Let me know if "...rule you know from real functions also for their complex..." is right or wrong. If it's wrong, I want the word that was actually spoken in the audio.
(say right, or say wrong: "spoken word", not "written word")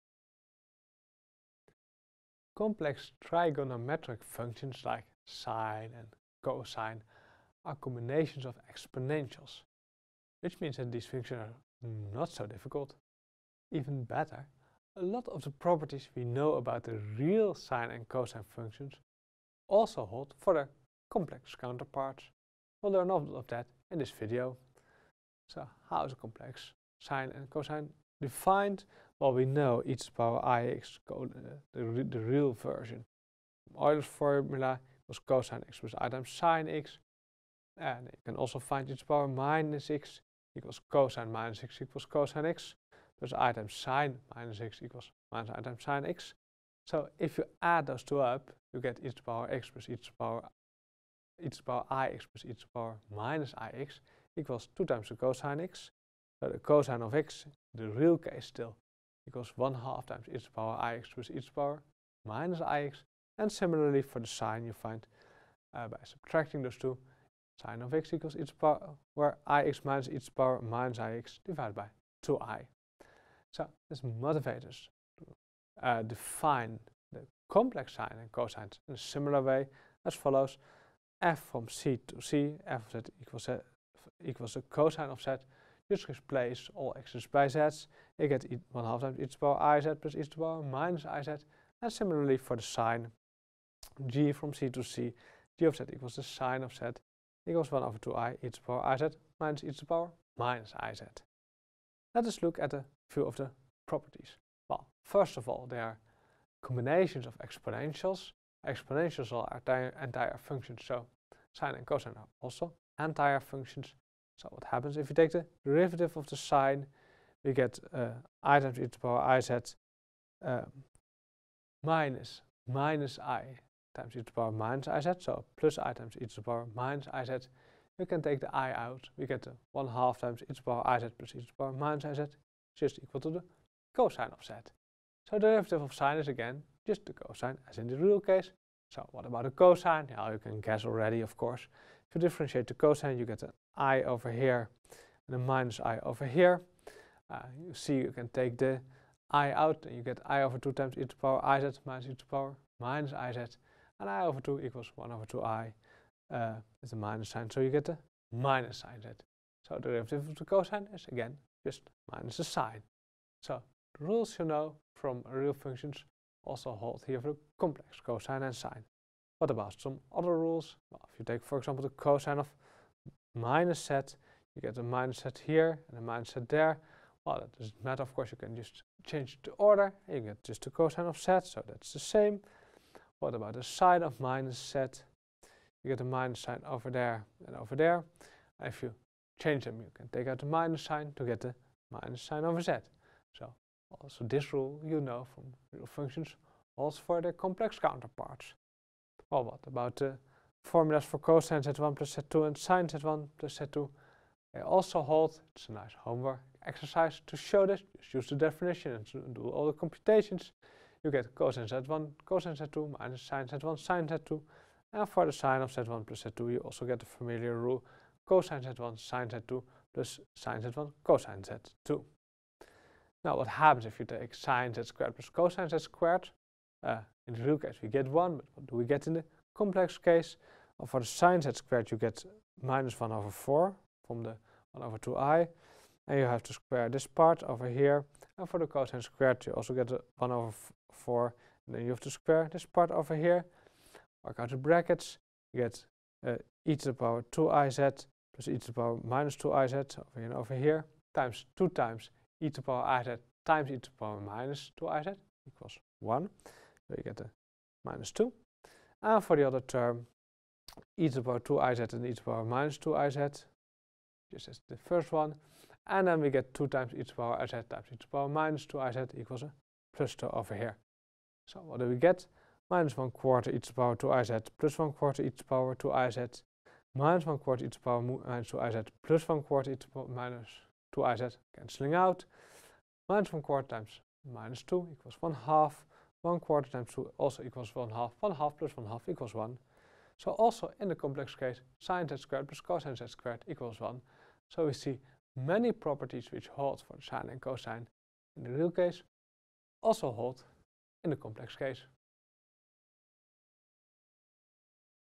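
right.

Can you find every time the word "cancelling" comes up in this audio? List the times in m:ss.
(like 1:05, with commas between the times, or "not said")
4:41.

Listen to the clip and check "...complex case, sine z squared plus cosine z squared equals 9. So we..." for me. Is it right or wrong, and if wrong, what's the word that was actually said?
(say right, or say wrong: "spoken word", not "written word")
wrong: "1", not "9".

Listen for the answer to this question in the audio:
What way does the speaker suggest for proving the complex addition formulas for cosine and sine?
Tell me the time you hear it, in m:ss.
3:25.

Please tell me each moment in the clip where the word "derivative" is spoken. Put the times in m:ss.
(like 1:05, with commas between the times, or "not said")
1:55, 2:15, 2:39.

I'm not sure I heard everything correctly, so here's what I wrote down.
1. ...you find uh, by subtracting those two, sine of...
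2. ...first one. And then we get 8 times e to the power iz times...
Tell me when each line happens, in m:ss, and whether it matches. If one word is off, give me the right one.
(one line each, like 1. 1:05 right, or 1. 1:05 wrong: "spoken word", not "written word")
1. 1:04 right
2. 4:24 wrong: "2", not "8".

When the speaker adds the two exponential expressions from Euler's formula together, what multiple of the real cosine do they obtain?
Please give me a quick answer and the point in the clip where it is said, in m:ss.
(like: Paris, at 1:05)
2 times the cosine, at 0:54.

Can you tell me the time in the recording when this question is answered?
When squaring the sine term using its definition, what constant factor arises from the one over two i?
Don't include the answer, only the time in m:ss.
3:52.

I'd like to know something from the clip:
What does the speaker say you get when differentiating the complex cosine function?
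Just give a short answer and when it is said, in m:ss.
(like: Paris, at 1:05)
Minus the sine, at 2:42.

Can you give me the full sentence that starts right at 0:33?
Euler's formula was cosine x plus i times sine x.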